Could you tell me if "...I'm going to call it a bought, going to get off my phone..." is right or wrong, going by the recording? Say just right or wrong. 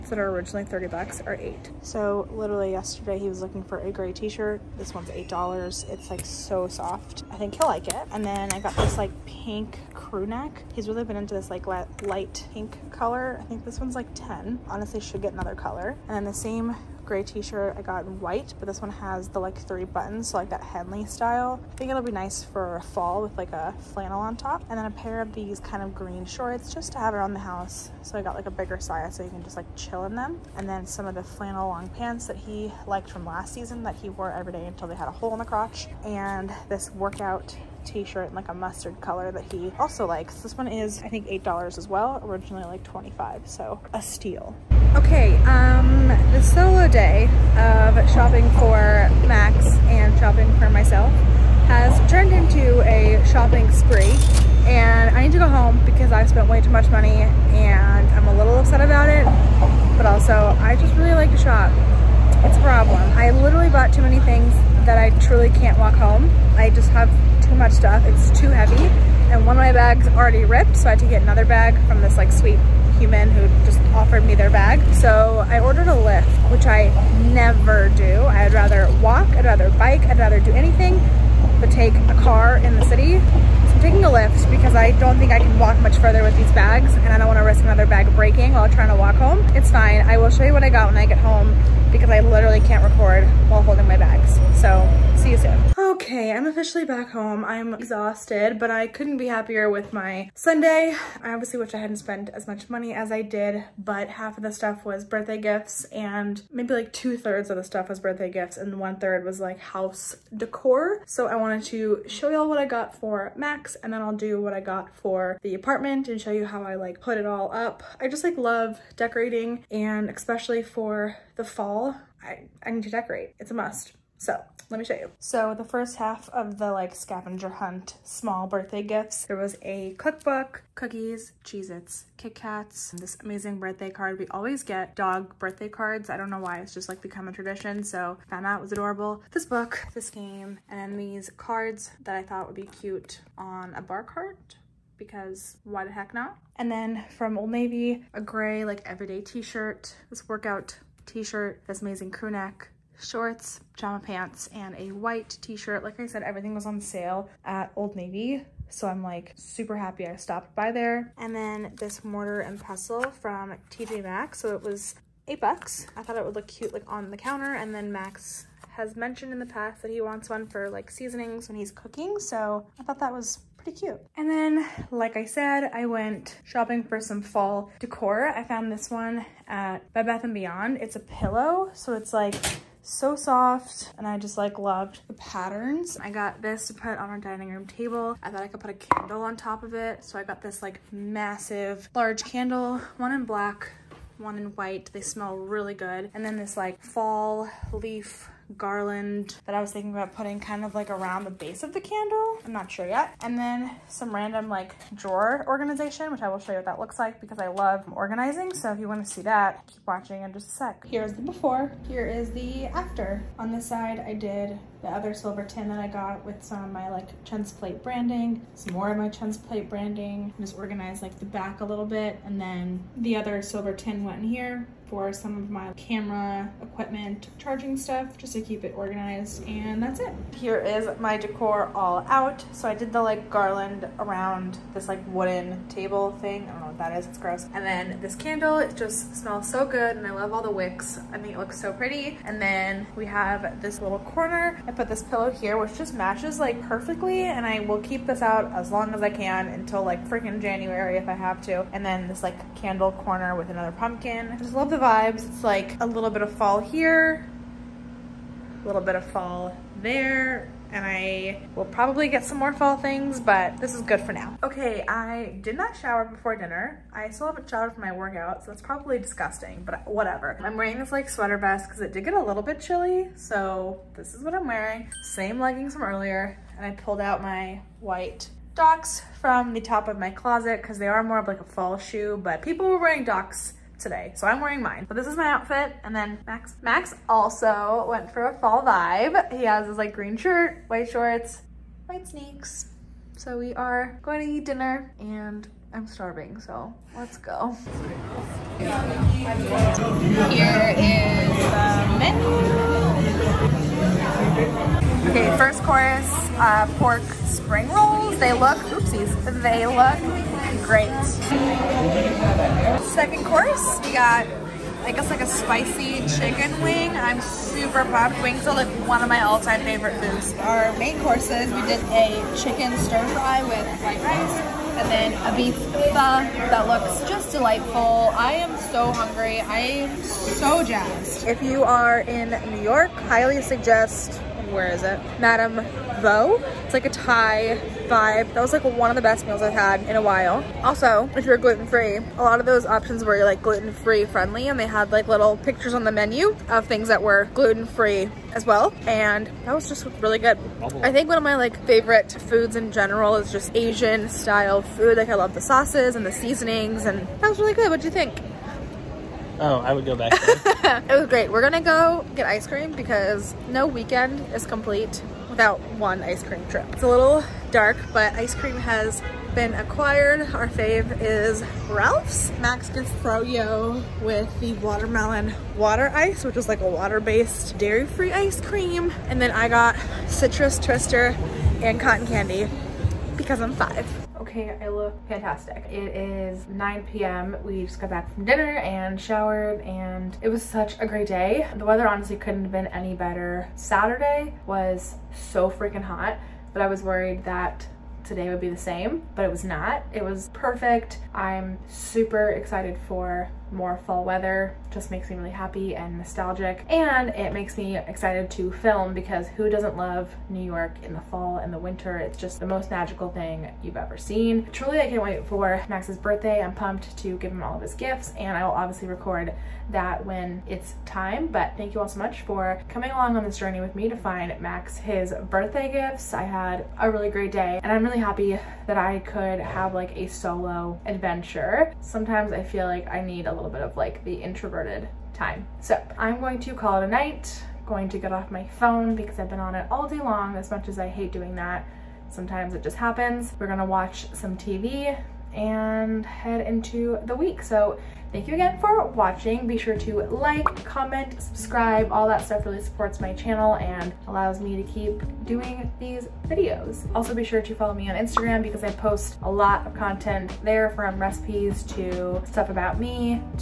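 wrong.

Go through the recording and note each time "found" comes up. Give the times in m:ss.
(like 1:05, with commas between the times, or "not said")
2:18, 2:58.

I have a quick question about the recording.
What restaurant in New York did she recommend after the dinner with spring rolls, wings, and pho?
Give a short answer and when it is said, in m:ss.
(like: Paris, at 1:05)
Madame Vo, at 5:35.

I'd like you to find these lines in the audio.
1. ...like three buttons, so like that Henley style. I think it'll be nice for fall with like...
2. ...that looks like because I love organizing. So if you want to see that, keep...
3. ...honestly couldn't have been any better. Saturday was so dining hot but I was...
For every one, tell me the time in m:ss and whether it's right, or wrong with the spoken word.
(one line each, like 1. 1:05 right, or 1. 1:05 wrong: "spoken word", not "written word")
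1. 0:19 right
2. 3:26 right
3. 6:31 wrong: "freaking", not "dining".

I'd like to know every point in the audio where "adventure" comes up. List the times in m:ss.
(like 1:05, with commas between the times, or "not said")
7:10.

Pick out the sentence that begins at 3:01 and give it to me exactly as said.
So it's like so soft and I just like loved the patterns.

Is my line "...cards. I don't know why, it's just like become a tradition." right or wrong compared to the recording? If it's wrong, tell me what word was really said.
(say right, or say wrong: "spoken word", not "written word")
right.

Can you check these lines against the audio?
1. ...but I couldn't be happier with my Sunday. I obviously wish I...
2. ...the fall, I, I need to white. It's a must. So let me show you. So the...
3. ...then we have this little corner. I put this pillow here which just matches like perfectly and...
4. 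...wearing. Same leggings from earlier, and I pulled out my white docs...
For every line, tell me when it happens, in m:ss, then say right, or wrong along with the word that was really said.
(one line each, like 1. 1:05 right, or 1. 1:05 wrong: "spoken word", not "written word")
1. 1:38 right
2. 2:01 wrong: "decorate", not "white"
3. 4:02 right
4. 4:34 right.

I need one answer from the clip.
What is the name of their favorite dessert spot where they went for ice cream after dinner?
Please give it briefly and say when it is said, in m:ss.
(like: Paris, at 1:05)
Ralph's, at 6:11.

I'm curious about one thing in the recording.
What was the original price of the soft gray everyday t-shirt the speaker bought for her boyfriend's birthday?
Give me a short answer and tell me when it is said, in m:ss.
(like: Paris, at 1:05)
$30, at 0:00.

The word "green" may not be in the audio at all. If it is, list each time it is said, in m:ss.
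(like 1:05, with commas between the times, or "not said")
0:25, 4:49.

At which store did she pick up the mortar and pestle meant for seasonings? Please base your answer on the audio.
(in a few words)
TJ Maxx.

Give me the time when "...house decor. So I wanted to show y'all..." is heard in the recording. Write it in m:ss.
1:49.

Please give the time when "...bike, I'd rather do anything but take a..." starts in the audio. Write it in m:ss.
1:19.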